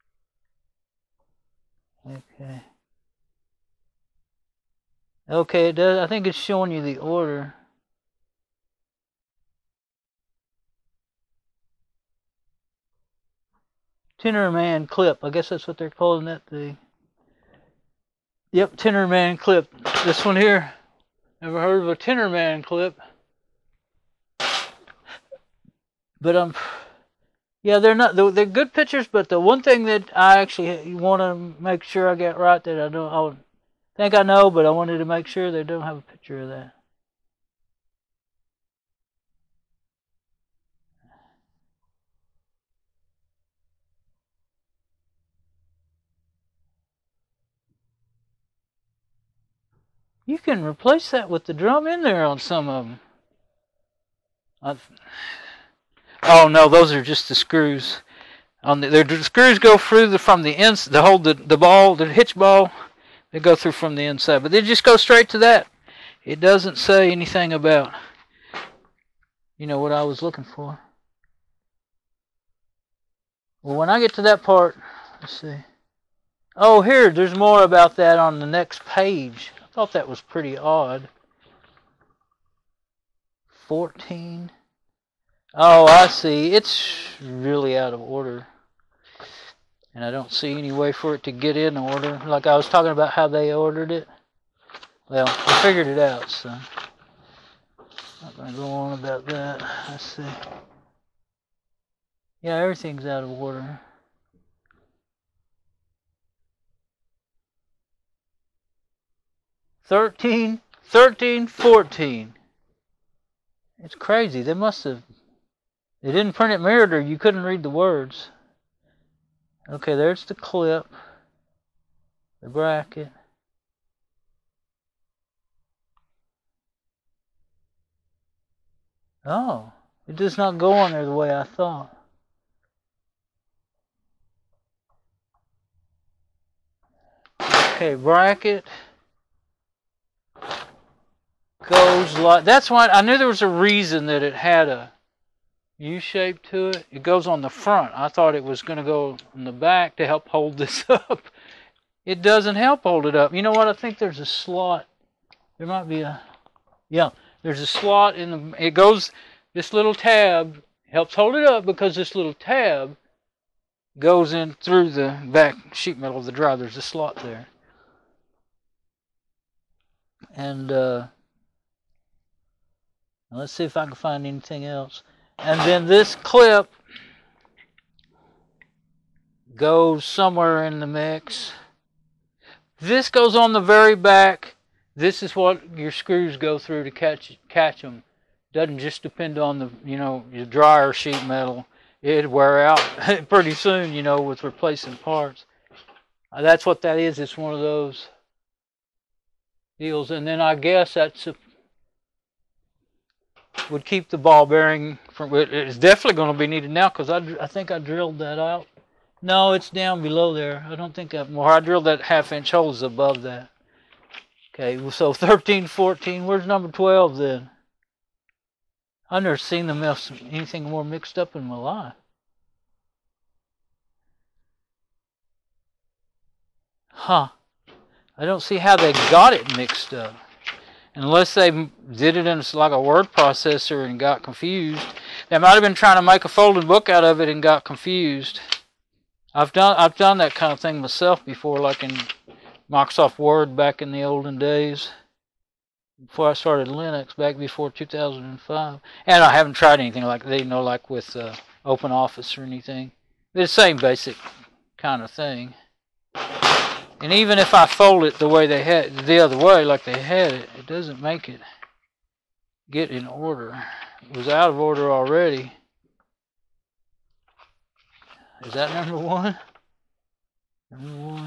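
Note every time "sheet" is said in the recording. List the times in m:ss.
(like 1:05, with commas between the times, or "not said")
2:45, 3:10.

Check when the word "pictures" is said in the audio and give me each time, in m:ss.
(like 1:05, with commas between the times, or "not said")
0:28, 0:36.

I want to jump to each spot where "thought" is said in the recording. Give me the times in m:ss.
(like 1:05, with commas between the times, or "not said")
1:19, 2:11, 2:28.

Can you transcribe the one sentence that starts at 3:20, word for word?
And then I guess that's a would keep the ball bearing from.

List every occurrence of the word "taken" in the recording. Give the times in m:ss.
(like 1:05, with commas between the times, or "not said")
not said.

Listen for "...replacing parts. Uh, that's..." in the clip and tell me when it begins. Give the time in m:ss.
3:14.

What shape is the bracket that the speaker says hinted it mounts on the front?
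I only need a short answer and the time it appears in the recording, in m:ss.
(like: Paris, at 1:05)
U-shape, at 2:25.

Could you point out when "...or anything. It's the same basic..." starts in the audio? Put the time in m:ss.
4:12.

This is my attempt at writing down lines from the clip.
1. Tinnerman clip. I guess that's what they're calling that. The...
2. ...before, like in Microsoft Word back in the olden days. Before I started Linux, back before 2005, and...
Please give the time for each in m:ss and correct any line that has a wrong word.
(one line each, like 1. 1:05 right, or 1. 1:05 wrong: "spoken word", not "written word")
1. 0:14 right
2. 4:01 right.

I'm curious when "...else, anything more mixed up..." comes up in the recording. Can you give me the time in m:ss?
3:39.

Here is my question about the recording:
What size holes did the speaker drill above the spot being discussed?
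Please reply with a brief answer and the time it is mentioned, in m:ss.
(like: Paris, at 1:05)
half inch, at 3:32.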